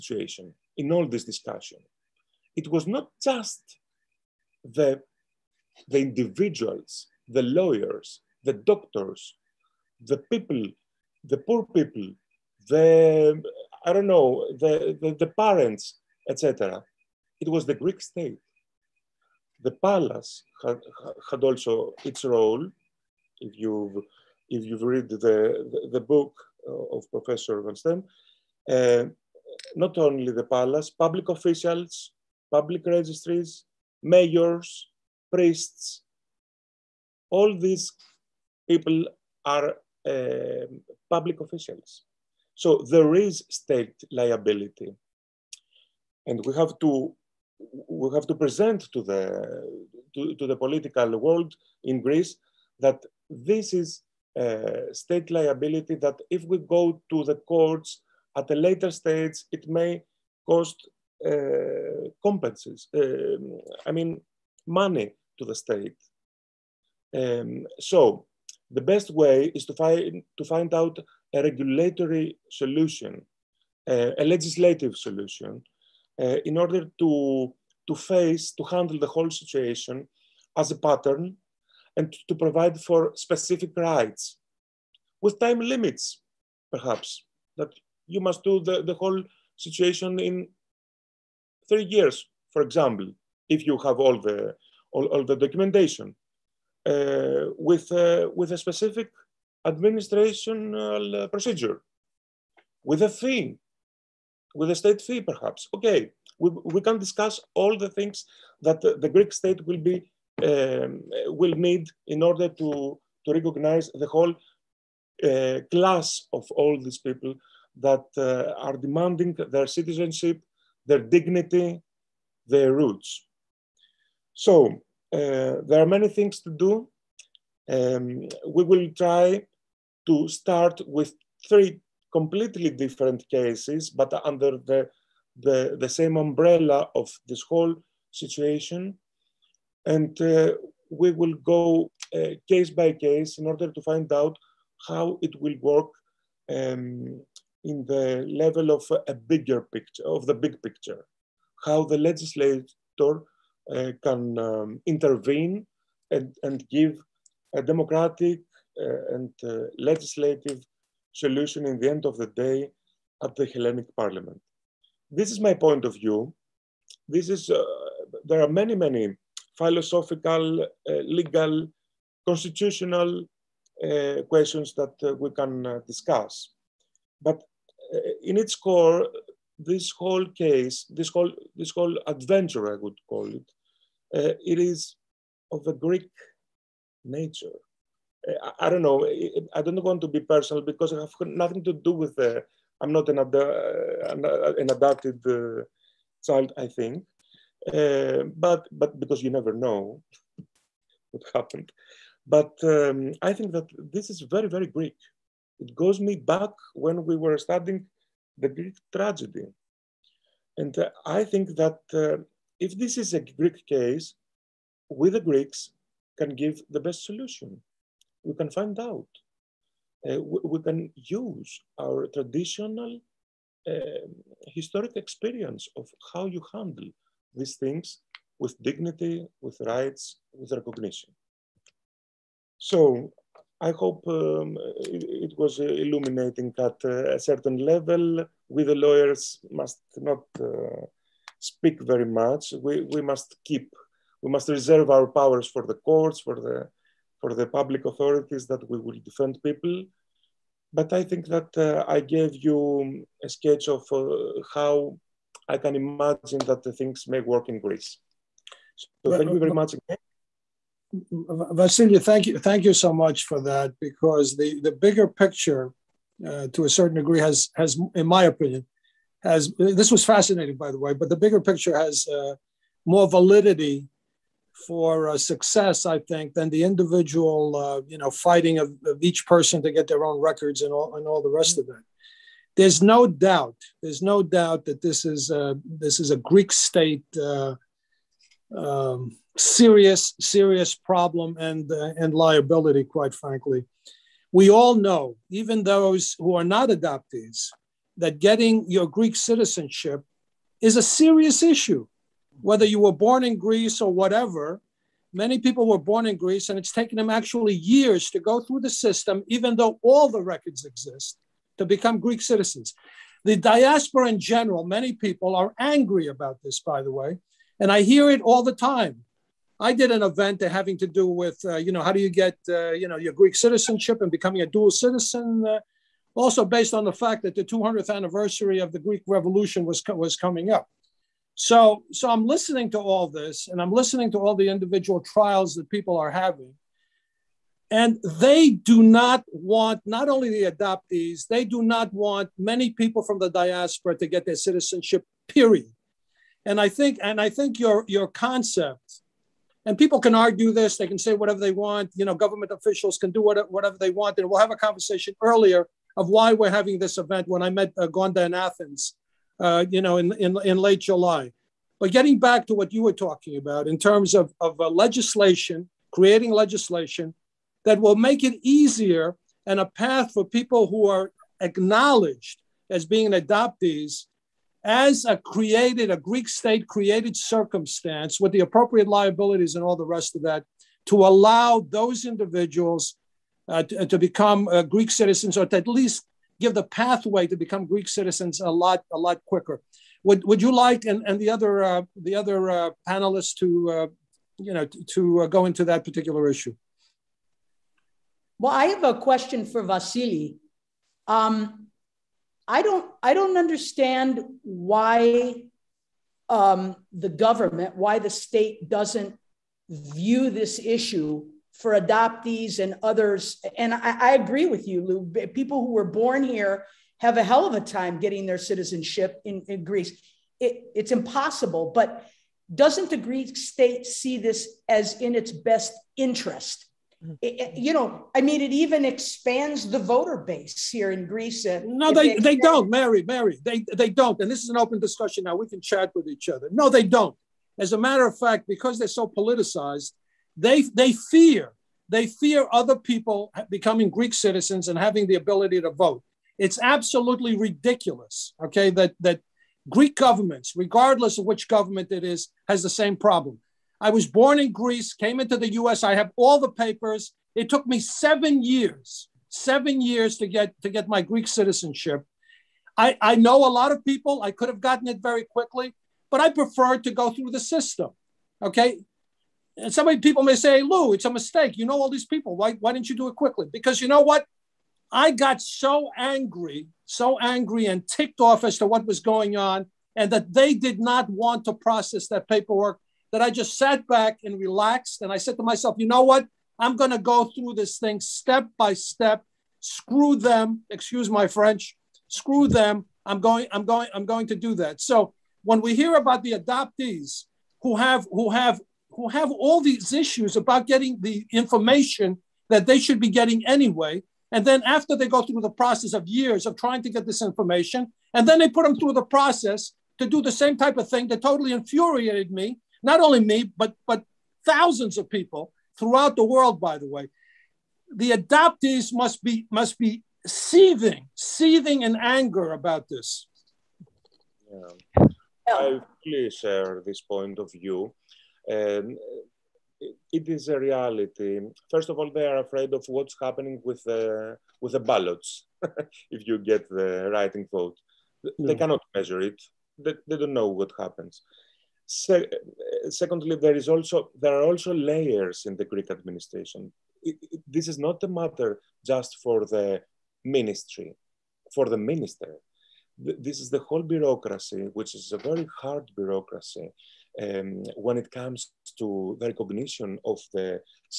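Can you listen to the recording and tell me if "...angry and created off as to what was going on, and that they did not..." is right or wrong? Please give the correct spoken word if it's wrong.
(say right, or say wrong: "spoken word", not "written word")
wrong: "ticked", not "created".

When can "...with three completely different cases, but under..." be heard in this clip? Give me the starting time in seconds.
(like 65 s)
130 s.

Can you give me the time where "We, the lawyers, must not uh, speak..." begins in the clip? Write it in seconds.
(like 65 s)
238 s.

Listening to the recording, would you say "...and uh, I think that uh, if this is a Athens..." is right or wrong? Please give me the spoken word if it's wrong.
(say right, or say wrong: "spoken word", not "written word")
wrong: "Greek", not "Athens".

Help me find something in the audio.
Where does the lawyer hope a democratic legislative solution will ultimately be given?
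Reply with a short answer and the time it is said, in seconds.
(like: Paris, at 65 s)
Hellenic Parliament, at 163 s.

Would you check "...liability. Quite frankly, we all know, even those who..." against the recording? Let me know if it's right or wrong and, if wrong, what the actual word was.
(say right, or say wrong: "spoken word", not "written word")
right.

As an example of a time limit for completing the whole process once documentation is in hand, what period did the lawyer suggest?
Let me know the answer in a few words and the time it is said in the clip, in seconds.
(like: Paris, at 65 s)
3 years, at 91 s.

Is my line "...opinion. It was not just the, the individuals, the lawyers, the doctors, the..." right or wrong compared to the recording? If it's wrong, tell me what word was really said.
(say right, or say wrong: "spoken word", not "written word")
wrong: "discussion", not "opinion".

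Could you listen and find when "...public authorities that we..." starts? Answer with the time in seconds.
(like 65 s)
247 s.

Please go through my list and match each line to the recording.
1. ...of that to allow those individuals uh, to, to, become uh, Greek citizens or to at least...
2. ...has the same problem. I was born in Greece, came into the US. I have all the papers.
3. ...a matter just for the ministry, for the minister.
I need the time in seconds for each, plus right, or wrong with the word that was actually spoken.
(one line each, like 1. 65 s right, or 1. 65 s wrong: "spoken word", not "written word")
1. 380 s right
2. 452 s right
3. 548 s right.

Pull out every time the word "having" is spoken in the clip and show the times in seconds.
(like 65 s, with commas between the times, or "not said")
320 s, 336 s, 356 s, 444 s.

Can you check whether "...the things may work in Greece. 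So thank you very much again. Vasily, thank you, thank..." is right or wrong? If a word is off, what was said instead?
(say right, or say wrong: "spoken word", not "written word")
right.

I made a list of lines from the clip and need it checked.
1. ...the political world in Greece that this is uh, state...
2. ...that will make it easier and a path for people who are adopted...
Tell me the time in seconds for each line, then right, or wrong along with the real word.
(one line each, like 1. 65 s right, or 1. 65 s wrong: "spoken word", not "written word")
1. 50 s right
2. 367 s wrong: "acknowledged", not "adopted".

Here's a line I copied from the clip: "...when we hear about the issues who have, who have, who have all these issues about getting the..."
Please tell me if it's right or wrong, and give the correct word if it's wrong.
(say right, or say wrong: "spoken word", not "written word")
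wrong: "adoptees", not "issues".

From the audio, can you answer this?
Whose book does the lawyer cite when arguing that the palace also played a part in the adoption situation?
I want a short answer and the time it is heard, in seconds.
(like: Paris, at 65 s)
Professor Van Steen, at 27 s.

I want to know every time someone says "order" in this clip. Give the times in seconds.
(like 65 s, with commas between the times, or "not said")
76 s, 112 s, 143 s.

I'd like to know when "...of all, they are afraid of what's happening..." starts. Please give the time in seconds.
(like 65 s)
531 s.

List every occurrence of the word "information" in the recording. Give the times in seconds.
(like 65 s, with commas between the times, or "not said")
501 s, 507 s.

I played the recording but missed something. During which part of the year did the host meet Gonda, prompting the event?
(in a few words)
Late July.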